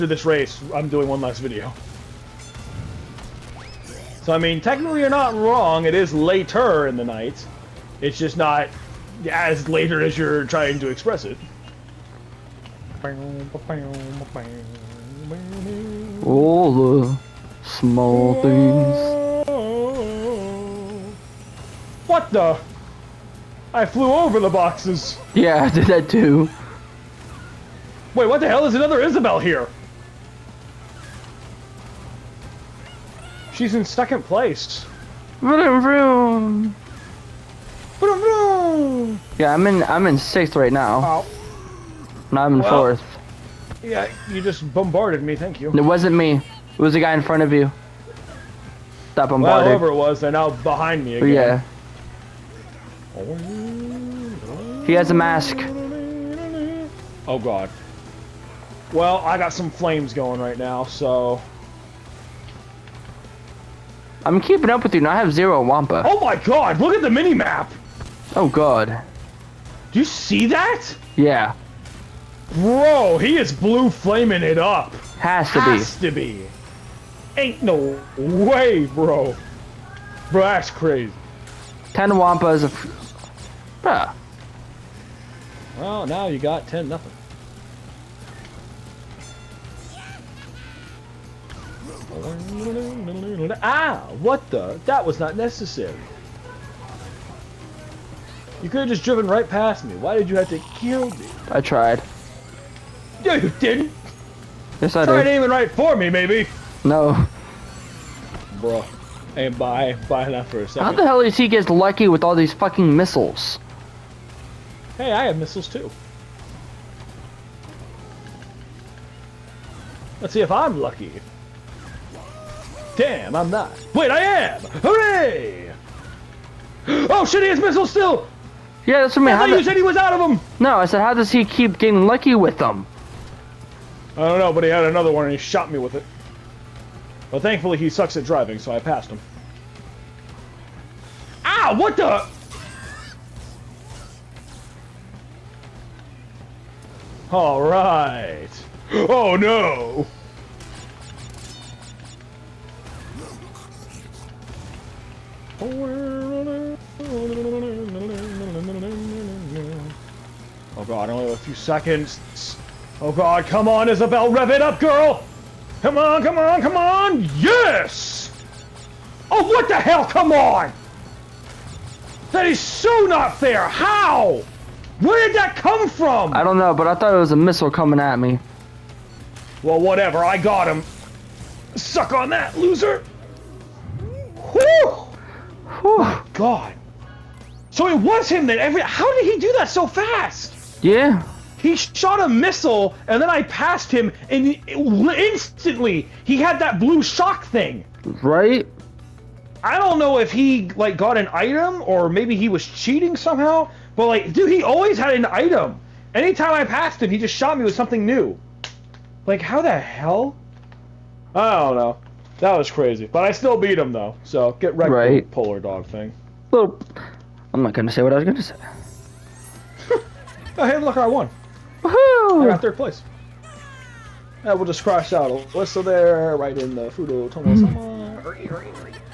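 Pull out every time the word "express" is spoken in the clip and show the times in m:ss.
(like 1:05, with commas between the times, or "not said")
0:10.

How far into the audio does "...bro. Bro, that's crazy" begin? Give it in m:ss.
1:18.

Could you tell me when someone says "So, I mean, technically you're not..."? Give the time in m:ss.
0:04.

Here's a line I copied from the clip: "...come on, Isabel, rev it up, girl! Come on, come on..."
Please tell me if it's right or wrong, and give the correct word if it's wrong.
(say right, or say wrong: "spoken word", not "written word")
right.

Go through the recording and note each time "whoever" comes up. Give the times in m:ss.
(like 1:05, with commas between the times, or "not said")
0:49.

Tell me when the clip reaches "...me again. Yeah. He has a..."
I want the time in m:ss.
0:51.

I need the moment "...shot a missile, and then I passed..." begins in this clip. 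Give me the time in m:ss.
3:11.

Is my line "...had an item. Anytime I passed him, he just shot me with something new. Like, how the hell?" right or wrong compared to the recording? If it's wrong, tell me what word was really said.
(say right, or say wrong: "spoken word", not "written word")
right.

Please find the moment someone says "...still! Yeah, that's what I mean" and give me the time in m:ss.
2:07.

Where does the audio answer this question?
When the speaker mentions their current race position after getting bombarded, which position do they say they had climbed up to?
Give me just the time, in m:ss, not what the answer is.
0:42.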